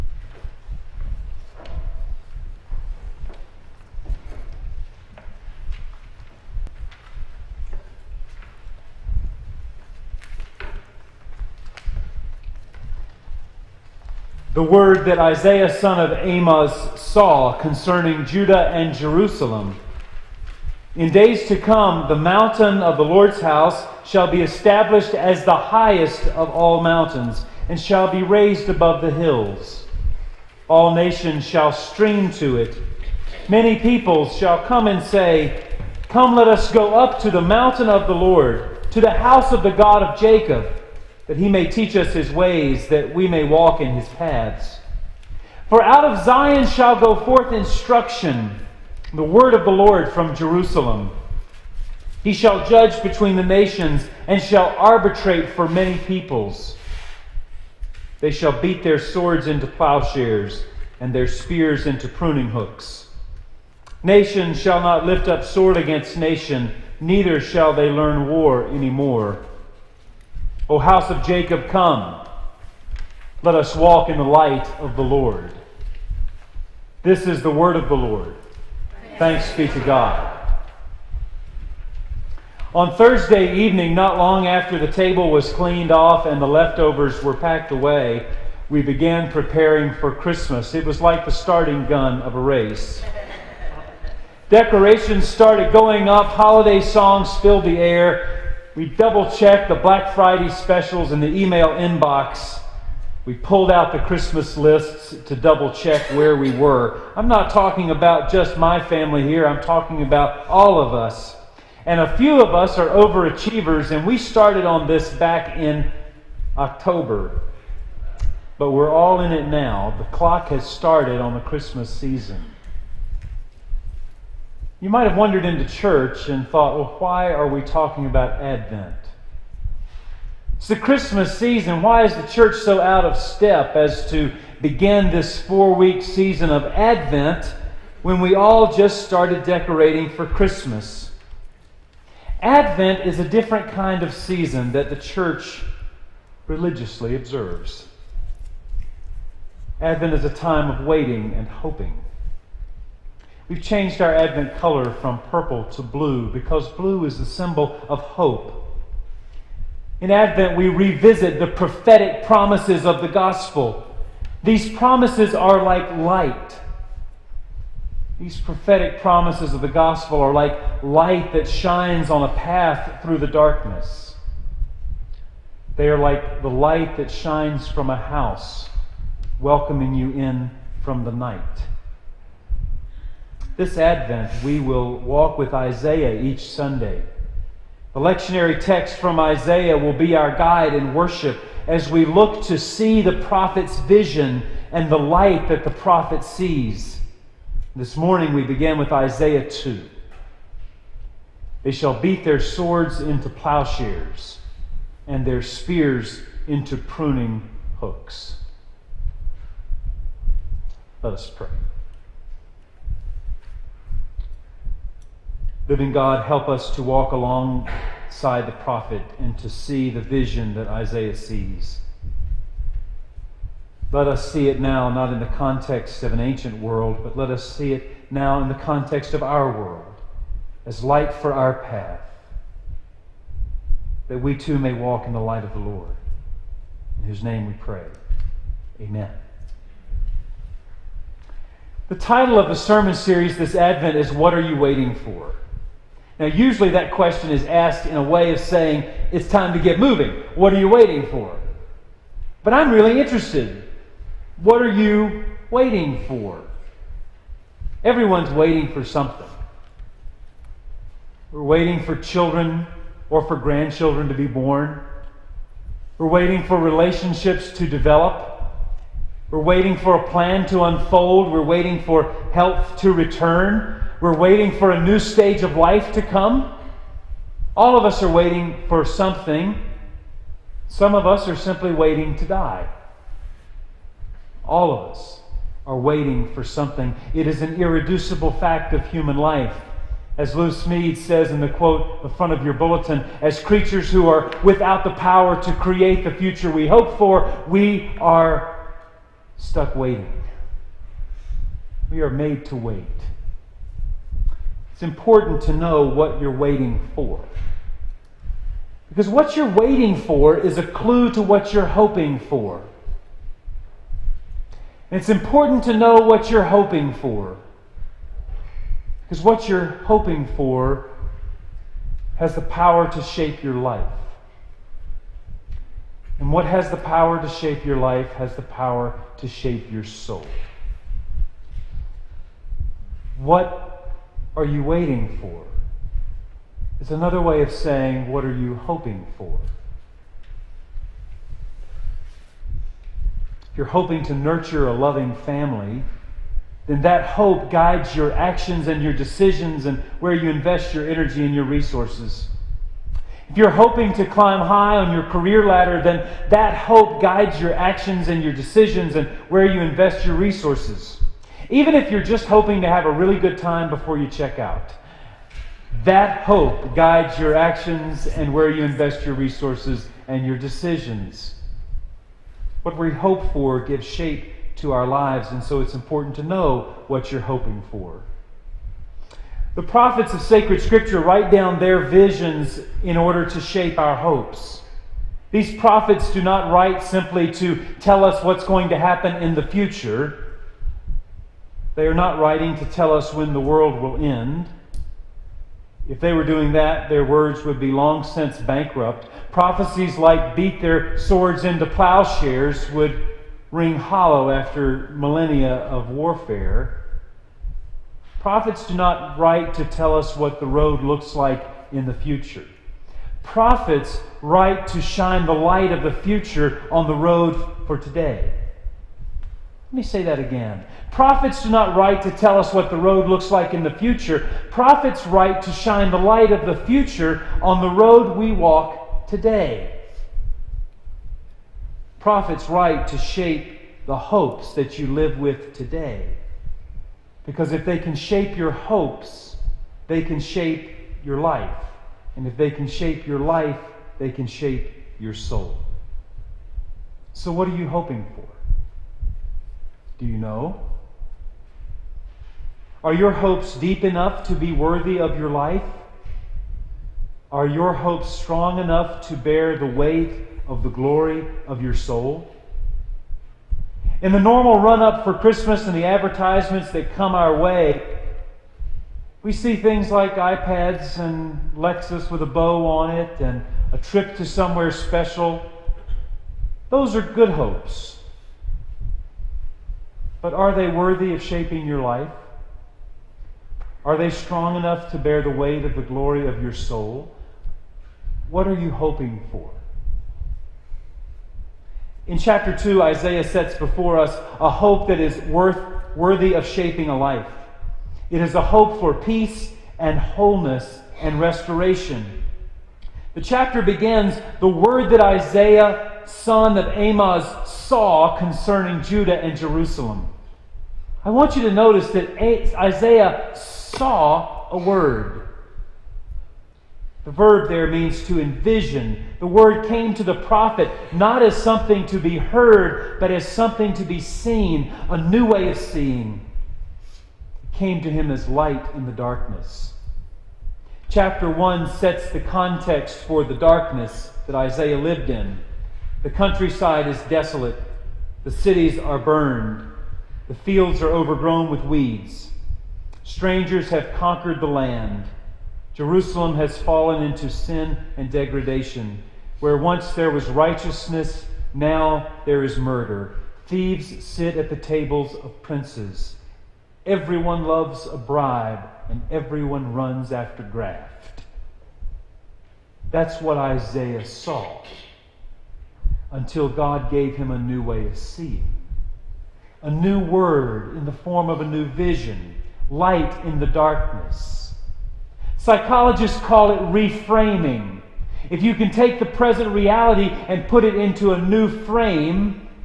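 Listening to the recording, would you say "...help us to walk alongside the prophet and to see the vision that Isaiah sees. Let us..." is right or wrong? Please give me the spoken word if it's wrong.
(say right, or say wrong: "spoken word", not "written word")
right.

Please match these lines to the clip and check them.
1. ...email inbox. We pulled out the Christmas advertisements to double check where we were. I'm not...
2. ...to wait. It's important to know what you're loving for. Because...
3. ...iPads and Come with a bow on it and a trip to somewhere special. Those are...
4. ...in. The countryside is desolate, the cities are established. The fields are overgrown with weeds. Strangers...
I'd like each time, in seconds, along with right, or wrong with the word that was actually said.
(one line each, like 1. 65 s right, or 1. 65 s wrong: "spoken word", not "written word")
1. 101 s wrong: "lists", not "advertisements"
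2. 302 s wrong: "waiting", not "loving"
3. 470 s wrong: "Lexus", not "Come"
4. 535 s wrong: "burned", not "established".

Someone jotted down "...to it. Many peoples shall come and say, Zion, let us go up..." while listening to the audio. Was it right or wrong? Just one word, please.
wrong.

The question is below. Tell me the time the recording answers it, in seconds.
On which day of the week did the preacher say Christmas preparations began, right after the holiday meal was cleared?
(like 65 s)
82 s.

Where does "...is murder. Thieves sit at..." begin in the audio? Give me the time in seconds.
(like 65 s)
552 s.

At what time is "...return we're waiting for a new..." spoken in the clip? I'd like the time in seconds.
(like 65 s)
272 s.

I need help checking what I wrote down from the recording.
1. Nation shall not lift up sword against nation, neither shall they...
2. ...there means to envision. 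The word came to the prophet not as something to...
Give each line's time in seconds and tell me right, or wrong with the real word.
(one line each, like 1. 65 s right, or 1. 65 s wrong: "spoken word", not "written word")
1. 64 s right
2. 517 s right.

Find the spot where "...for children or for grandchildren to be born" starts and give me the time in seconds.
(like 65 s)
261 s.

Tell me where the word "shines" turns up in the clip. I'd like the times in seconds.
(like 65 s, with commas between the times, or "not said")
171 s, 177 s, 414 s, 425 s.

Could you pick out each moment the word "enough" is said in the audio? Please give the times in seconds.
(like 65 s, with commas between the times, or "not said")
453 s, 458 s, 484 s.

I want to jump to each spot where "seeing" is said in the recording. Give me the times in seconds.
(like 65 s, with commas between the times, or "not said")
525 s, 567 s.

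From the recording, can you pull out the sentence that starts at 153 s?
We've changed our Advent color from purple to blue because blue is the symbol of hope.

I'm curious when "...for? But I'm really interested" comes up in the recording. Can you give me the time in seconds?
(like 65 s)
251 s.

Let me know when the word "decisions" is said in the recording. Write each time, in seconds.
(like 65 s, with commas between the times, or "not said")
348 s, 358 s, 370 s.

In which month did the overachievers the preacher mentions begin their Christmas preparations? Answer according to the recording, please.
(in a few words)
October.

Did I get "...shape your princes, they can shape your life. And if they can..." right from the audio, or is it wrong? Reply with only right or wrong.
wrong.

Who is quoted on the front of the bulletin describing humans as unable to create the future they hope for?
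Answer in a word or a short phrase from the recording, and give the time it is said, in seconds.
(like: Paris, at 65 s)
Lou Smedes, at 290 s.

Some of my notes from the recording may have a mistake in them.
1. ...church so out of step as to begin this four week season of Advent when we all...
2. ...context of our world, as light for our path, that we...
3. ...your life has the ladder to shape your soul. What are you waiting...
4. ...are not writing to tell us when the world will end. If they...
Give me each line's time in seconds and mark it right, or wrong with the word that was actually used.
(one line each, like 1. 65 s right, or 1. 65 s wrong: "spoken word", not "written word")
1. 132 s right
2. 228 s right
3. 327 s wrong: "power", not "ladder"
4. 391 s right.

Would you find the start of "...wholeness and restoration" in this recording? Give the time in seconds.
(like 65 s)
499 s.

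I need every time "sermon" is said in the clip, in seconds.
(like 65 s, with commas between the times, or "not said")
242 s.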